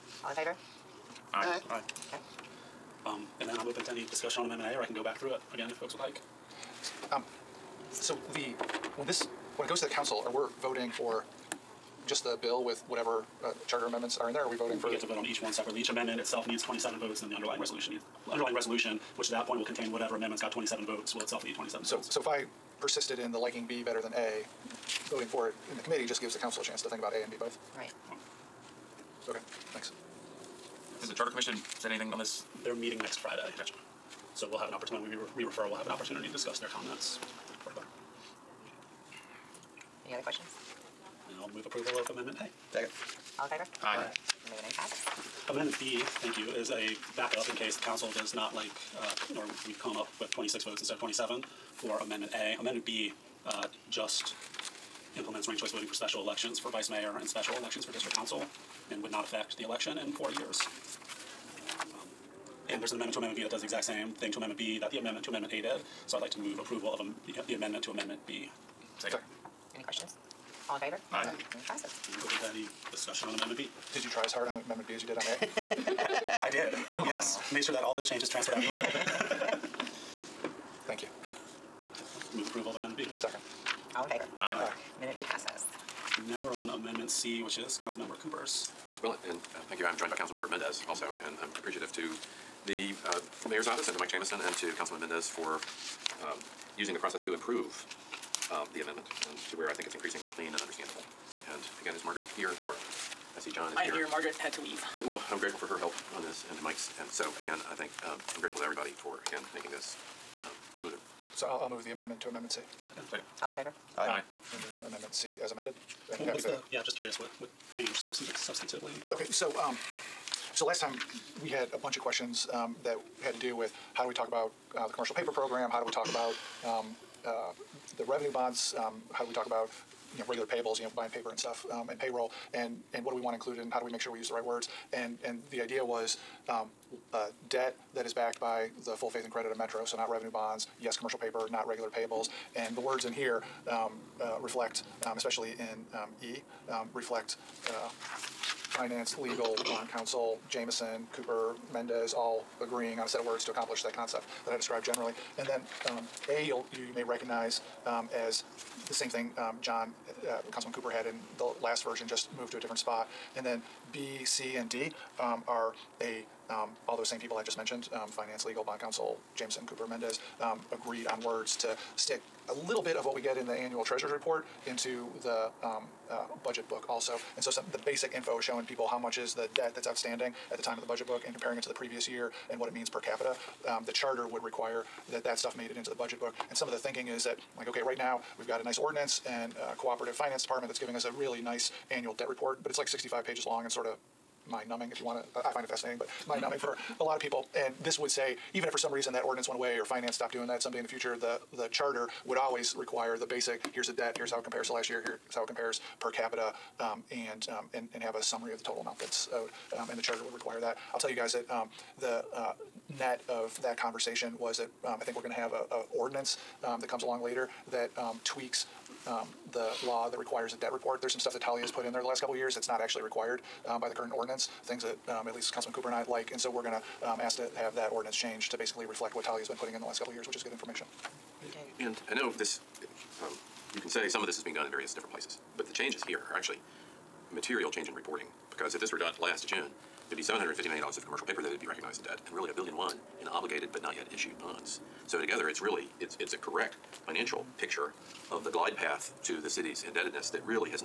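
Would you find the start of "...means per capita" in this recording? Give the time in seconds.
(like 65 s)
182 s.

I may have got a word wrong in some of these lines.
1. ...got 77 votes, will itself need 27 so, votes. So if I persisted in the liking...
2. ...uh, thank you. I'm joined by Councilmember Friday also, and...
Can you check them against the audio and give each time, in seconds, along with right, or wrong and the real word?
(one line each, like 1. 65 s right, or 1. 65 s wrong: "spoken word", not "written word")
1. 20 s wrong: "27", not "77"
2. 89 s wrong: "Mendes", not "Friday".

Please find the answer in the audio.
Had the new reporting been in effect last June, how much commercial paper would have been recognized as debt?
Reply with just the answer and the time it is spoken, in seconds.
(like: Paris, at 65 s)
$750 million, at 240 s.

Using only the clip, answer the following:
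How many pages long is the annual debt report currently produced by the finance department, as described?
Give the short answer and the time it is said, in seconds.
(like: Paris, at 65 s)
65, at 192 s.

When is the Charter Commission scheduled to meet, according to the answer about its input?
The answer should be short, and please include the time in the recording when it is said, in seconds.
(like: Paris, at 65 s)
next Friday, at 33 s.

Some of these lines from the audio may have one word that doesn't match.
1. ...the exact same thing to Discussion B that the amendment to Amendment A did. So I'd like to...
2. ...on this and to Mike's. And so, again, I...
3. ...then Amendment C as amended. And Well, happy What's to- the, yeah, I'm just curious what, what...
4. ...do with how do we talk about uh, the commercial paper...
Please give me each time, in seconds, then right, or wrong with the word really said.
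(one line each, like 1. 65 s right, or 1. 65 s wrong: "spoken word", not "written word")
1. 63 s wrong: "Amendment", not "Discussion"
2. 106 s right
3. 114 s right
4. 123 s right.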